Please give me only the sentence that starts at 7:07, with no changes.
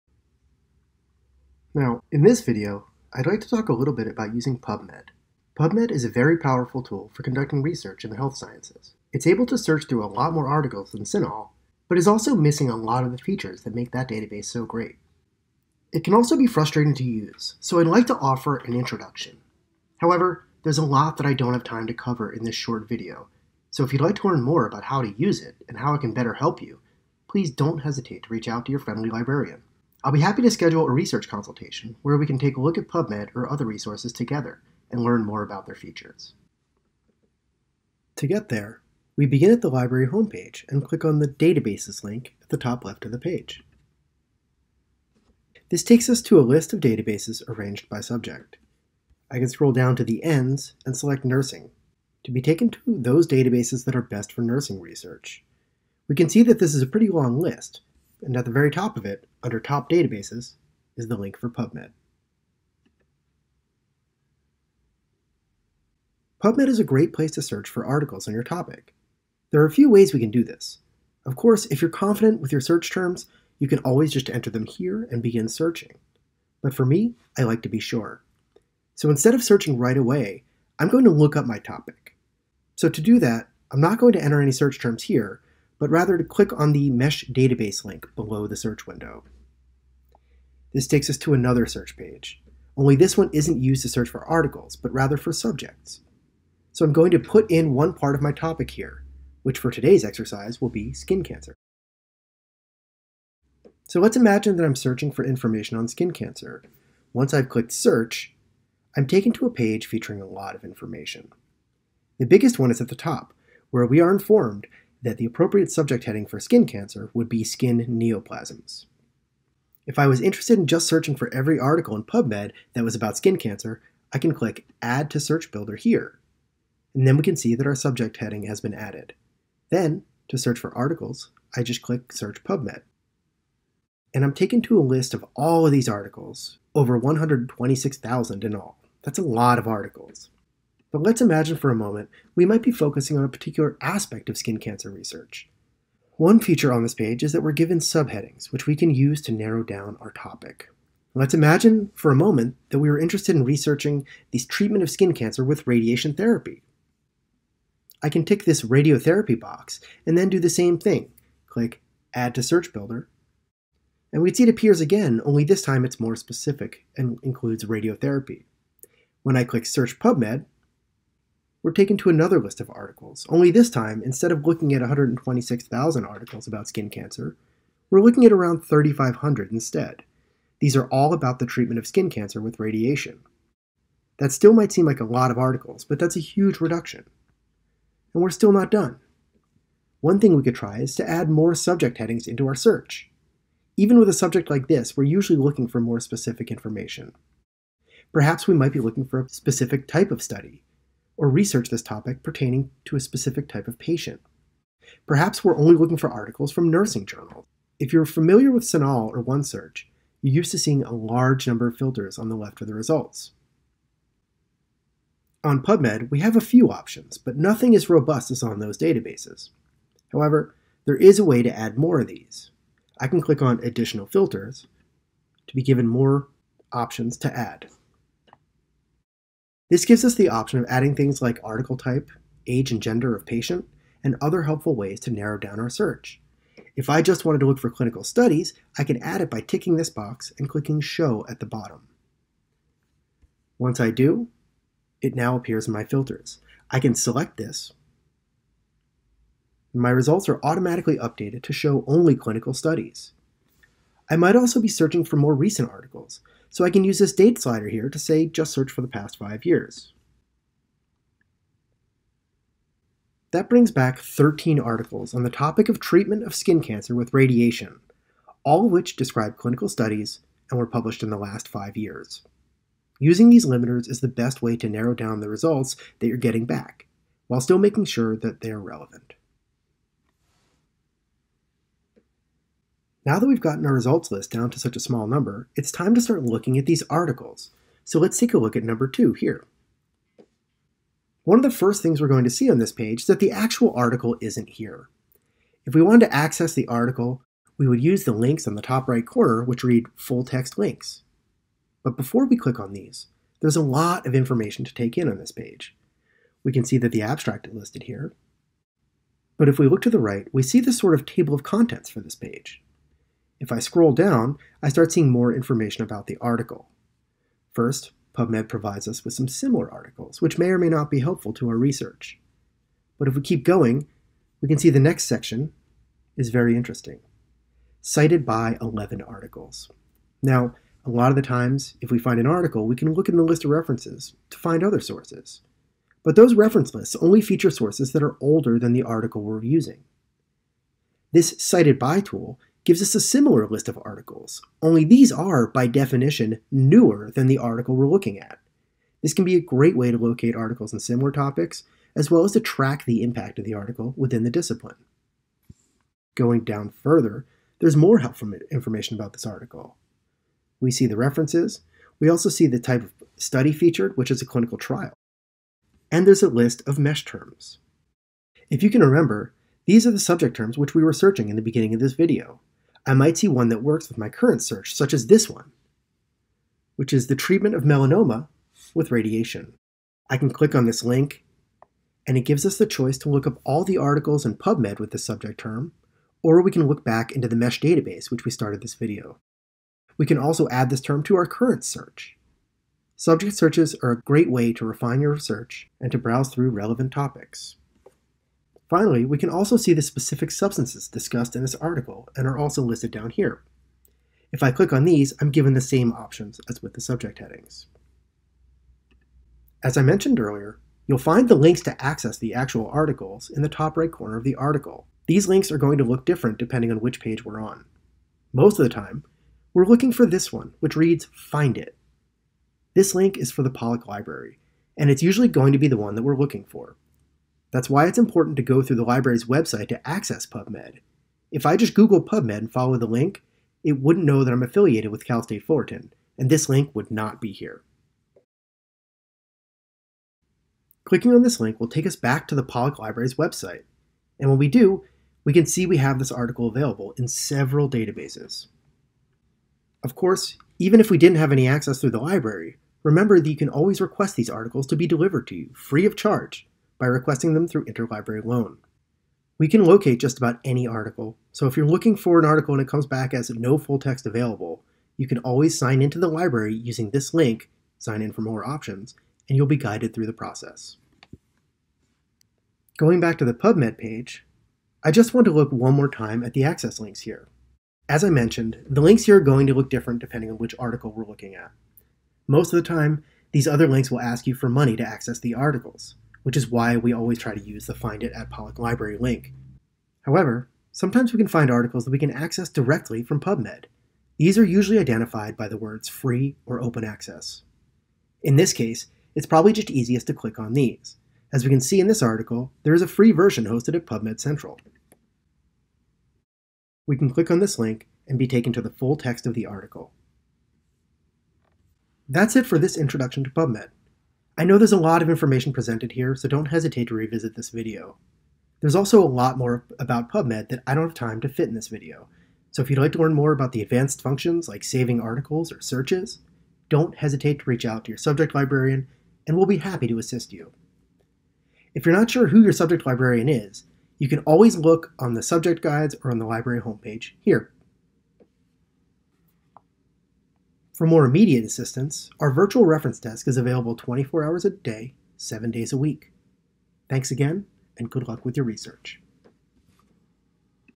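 That's why it's important to go through the library's website to access PubMed.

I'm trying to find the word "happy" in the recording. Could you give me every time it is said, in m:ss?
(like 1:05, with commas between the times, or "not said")
0:30, 8:49.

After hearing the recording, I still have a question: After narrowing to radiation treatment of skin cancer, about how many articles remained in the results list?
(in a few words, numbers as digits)
3,500.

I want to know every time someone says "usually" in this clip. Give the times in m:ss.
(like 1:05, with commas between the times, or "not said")
3:15, 7:05, 8:14.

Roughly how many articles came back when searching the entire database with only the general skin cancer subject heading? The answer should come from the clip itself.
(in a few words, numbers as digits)
126,000.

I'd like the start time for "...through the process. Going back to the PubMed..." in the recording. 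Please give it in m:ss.
7:49.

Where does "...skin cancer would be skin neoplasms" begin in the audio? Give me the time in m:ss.
1:56.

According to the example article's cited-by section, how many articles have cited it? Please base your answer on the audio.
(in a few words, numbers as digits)
11.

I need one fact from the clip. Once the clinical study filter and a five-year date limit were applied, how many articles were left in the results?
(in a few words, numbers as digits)
13.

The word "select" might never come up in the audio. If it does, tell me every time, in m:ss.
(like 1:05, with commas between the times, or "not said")
0:50, 4:06.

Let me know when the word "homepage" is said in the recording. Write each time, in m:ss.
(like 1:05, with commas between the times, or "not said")
0:40, 8:56.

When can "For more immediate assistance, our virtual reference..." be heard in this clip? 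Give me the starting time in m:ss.
9:00.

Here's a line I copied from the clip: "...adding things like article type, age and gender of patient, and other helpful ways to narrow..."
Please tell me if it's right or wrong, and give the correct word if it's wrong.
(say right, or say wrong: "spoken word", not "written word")
right.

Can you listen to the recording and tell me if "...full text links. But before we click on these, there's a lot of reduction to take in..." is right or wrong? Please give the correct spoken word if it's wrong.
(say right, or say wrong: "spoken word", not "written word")
wrong: "information", not "reduction".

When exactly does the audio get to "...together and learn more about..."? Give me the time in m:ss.
0:34.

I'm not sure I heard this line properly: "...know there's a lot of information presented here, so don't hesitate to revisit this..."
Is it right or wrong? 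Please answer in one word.
right.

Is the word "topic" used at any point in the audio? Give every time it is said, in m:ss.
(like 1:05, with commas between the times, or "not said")
1:08, 1:21, 1:38, 2:30, 3:21, 4:25, 5:51, 6:36.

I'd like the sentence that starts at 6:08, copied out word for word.
If you can remember, these are the subject terms which we were searching in the beginning of this video.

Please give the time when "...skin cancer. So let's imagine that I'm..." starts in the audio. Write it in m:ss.
1:40.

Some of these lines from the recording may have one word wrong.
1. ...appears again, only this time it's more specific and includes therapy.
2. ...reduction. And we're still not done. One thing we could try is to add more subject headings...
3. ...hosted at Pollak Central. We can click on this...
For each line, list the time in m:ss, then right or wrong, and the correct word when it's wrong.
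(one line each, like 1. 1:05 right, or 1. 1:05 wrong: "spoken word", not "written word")
1. 2:44 wrong: "radiotherapy", not "therapy"
2. 3:06 right
3. 8:23 wrong: "PubMed", not "Pollak".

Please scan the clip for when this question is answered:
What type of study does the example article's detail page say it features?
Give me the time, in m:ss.
6:04.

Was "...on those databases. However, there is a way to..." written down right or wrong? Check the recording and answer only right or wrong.
right.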